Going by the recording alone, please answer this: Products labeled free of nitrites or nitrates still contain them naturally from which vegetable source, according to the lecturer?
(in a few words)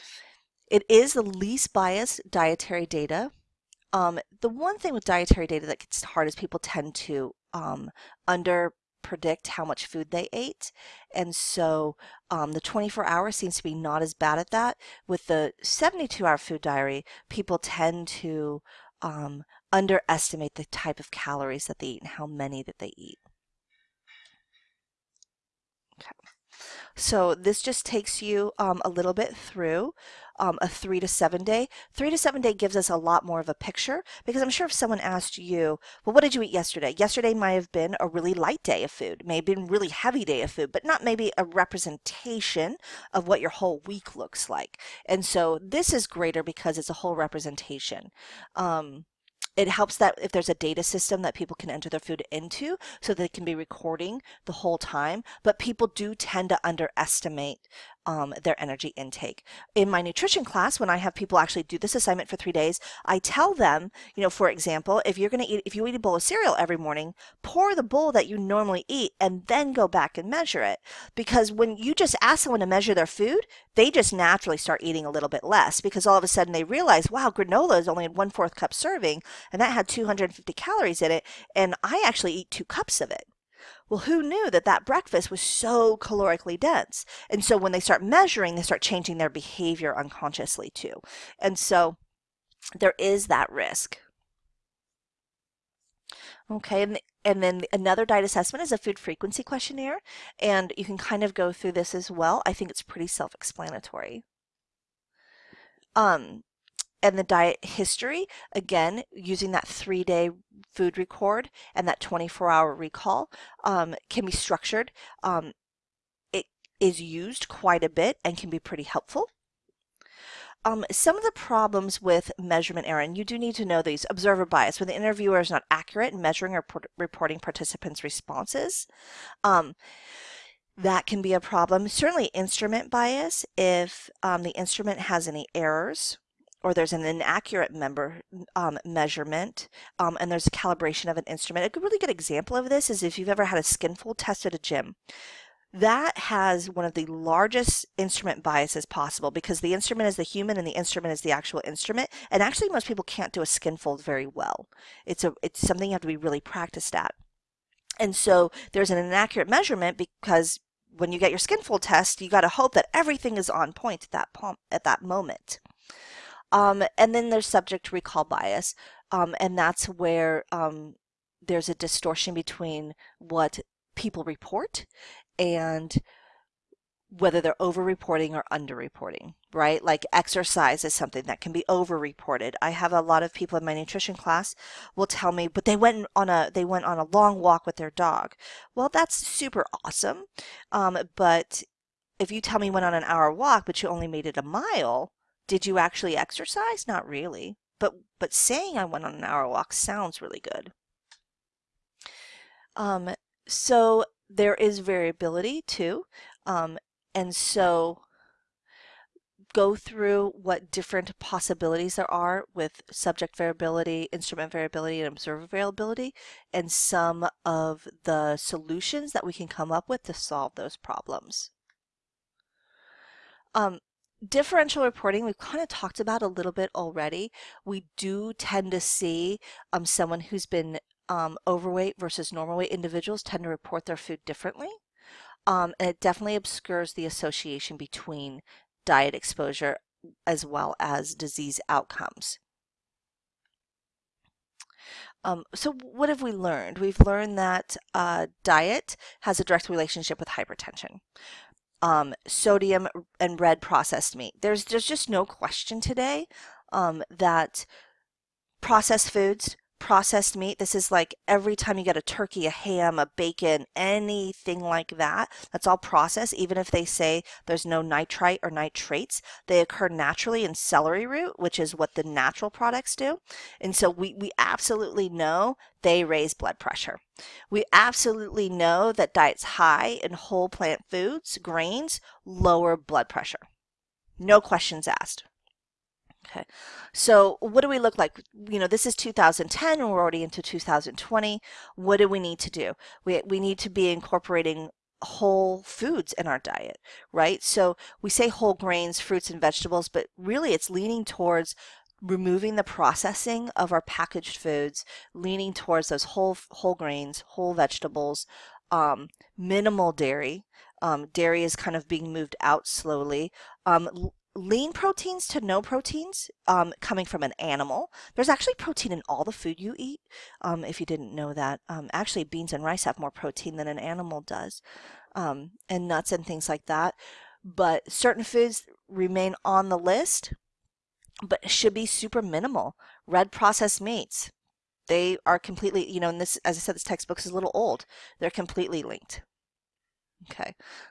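Celery root.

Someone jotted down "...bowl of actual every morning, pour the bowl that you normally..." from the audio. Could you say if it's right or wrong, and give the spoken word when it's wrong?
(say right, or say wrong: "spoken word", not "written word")
wrong: "cereal", not "actual".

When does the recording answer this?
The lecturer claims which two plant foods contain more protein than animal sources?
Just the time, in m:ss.
5:22.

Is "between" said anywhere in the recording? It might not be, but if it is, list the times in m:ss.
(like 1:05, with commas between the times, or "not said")
2:52, 3:57.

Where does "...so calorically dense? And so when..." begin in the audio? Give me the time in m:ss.
1:25.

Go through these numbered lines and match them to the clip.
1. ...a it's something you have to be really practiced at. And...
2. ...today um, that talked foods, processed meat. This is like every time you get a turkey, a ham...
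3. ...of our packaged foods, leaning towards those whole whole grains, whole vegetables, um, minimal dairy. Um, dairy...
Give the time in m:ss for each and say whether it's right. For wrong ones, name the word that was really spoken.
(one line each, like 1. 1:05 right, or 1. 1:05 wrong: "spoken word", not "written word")
1. 2:35 right
2. 4:15 wrong: "processed", not "talked"
3. 5:03 right.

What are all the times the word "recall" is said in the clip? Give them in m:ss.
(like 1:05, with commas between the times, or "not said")
1:52, 2:47.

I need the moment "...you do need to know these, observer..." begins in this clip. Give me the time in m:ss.
2:03.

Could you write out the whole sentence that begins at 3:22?
Um, so there is variability too.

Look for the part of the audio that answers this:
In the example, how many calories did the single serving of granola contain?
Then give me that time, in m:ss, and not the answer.
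1:19.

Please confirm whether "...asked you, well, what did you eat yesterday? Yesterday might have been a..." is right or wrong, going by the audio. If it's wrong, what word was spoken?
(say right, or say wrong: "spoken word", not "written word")
right.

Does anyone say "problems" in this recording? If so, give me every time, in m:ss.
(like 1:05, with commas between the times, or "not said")
2:01, 2:11, 3:40.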